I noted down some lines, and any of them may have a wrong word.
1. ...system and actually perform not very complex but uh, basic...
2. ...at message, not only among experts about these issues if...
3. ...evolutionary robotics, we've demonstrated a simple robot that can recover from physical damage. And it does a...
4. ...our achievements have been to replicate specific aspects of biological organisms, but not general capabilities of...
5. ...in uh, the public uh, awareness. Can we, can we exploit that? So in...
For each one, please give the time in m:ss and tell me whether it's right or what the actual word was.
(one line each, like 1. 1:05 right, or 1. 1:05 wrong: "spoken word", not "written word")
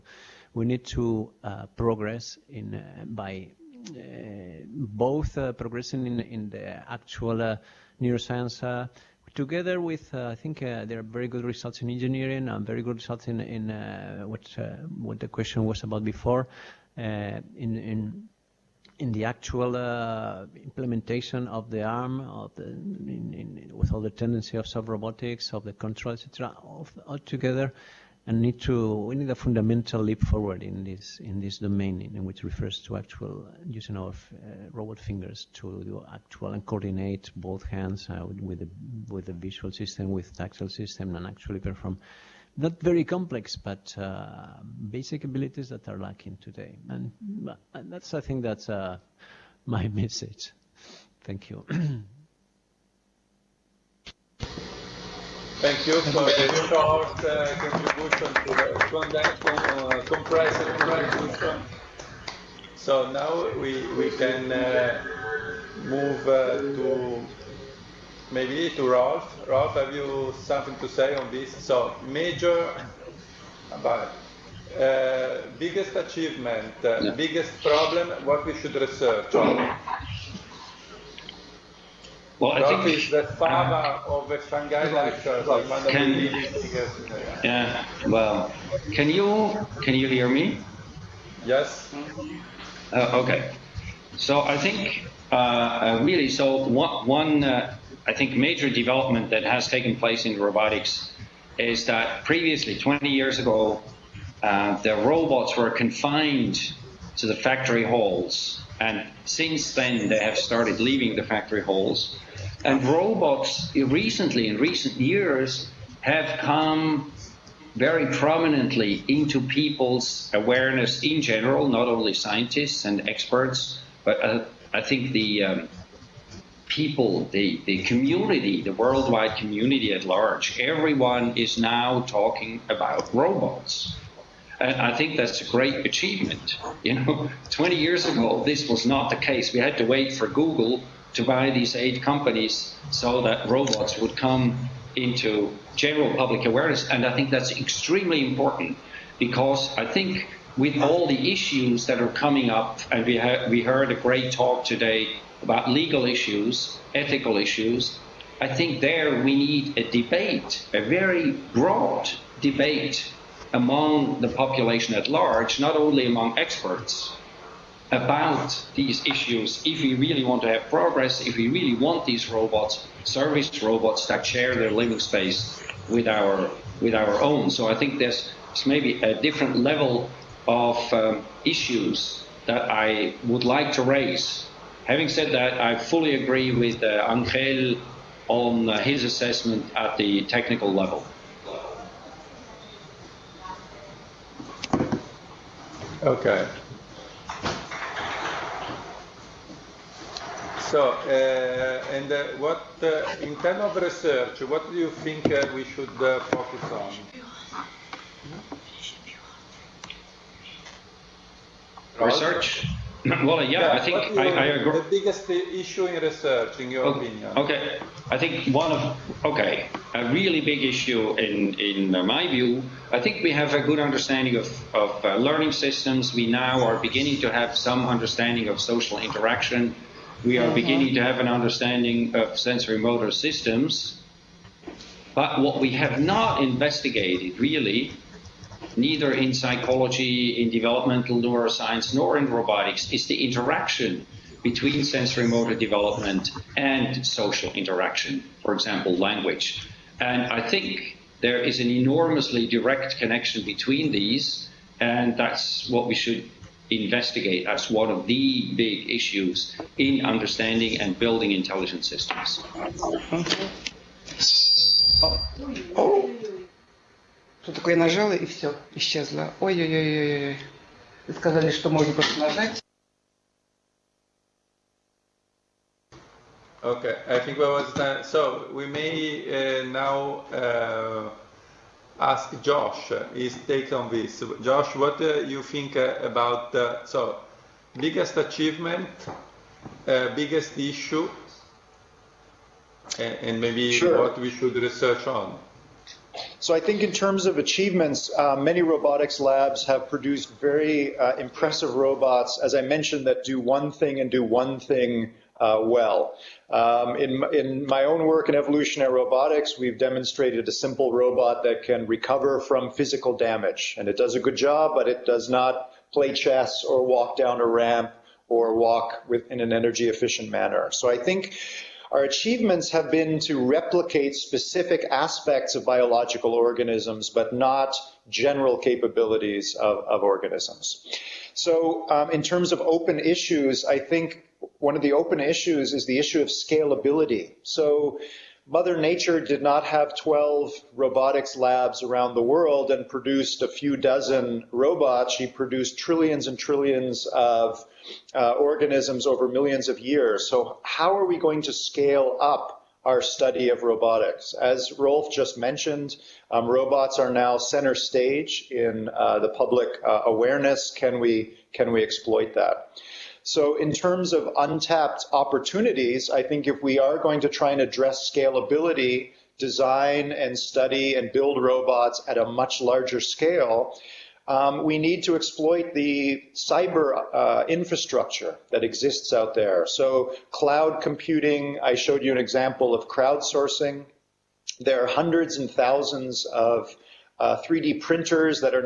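1. 0:40 right
2. 2:44 wrong: "large", not "message"
3. 5:08 right
4. 5:21 right
5. 5:58 right.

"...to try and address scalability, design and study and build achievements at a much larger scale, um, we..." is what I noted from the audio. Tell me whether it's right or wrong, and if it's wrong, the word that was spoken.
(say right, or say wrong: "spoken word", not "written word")
wrong: "robots", not "achievements".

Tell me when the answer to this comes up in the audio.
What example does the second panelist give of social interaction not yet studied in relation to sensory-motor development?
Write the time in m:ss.
4:08.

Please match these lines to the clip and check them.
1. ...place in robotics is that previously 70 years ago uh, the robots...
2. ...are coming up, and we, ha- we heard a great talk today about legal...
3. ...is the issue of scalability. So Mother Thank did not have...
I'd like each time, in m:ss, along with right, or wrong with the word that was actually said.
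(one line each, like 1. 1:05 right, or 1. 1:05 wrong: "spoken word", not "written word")
1. 1:39 wrong: "20", not "70"
2. 2:31 right
3. 5:35 wrong: "Nature", not "Thank".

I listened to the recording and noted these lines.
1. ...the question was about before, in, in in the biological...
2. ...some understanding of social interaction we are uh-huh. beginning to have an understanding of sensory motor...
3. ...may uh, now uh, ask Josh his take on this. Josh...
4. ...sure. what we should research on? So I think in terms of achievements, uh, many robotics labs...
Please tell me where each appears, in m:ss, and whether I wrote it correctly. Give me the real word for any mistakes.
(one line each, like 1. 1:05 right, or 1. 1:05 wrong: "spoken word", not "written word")
1. 0:15 wrong: "actual", not "biological"
2. 3:47 right
3. 4:38 right
4. 4:53 right.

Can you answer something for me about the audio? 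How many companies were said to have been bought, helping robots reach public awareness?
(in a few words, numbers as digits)
8.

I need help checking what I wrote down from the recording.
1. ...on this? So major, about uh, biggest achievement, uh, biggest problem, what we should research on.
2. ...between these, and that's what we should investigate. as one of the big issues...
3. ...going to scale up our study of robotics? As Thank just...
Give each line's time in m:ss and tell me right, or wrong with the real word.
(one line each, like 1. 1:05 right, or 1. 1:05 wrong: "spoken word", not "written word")
1. 1:11 right
2. 4:13 right
3. 5:51 wrong: "Rolf", not "Thank".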